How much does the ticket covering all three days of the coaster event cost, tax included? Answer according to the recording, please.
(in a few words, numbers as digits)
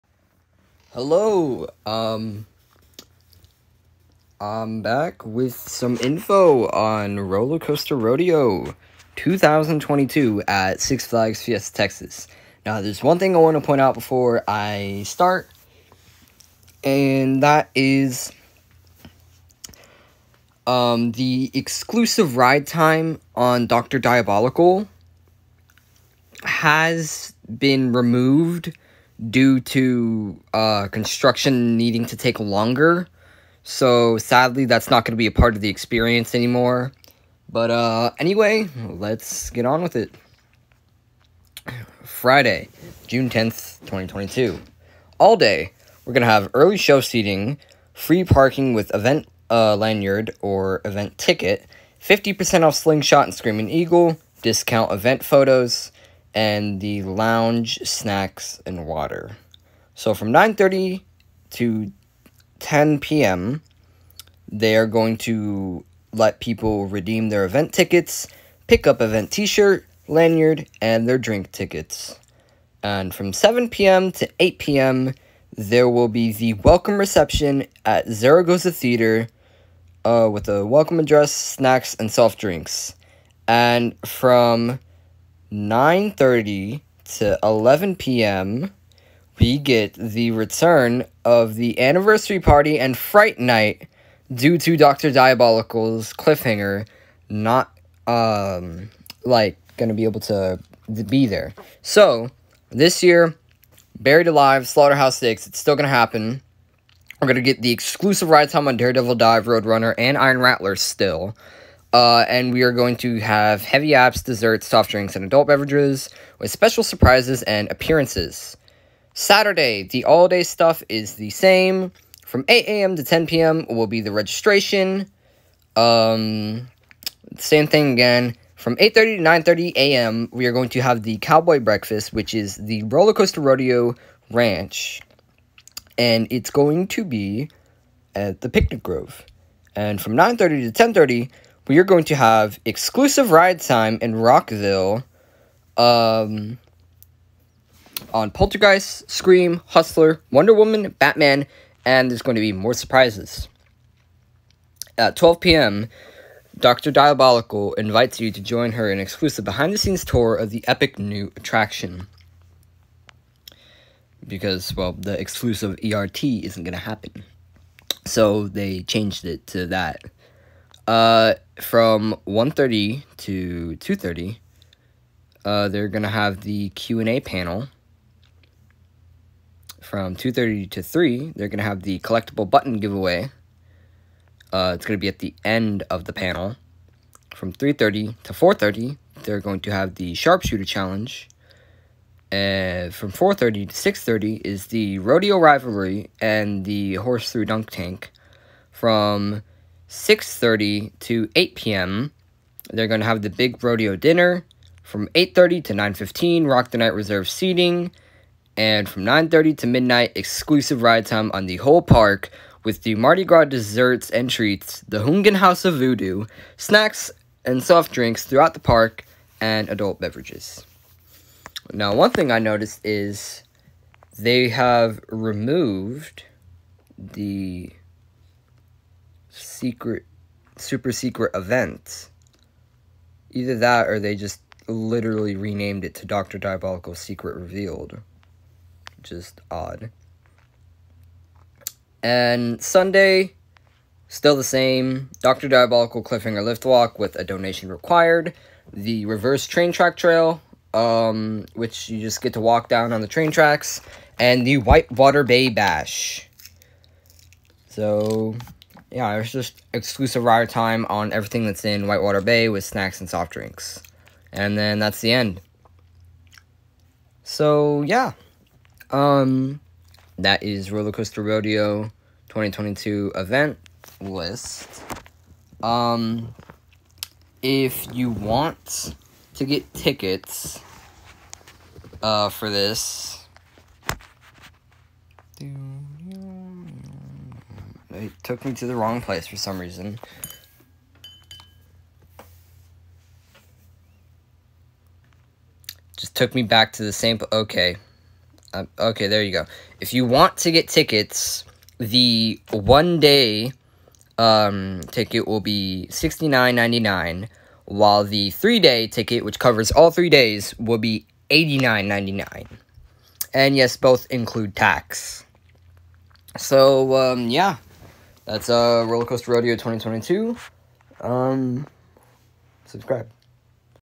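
$89.99.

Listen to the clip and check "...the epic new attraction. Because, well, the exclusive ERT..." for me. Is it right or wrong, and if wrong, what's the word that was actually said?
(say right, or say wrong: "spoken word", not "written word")
right.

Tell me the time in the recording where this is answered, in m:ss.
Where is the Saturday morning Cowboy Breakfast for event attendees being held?
2:18.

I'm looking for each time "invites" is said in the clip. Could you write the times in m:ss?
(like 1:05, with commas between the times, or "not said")
2:37.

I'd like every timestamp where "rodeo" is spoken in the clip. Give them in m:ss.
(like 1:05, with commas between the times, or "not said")
0:07, 2:13, 3:14, 3:23, 4:31, 5:19.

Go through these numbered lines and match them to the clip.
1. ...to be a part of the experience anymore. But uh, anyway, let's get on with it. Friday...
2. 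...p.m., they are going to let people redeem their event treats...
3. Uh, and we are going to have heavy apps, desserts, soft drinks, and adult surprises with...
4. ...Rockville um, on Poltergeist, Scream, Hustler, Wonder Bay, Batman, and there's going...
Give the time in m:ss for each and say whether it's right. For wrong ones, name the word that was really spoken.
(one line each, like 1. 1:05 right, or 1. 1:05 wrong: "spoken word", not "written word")
1. 0:35 right
2. 1:02 wrong: "tickets", not "treats"
3. 1:51 wrong: "beverages", not "surprises"
4. 2:24 wrong: "Woman", not "Bay".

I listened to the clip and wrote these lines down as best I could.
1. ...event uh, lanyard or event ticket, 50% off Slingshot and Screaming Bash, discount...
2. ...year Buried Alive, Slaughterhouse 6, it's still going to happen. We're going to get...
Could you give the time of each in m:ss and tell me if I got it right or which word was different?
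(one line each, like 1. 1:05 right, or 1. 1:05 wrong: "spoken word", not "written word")
1. 0:48 wrong: "Eagle", not "Bash"
2. 1:43 right.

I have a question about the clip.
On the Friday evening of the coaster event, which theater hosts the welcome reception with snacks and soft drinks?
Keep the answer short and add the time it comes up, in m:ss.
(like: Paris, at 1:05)
Zaragoza Theater, at 1:18.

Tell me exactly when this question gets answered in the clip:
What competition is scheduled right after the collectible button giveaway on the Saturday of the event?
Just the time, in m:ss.
3:10.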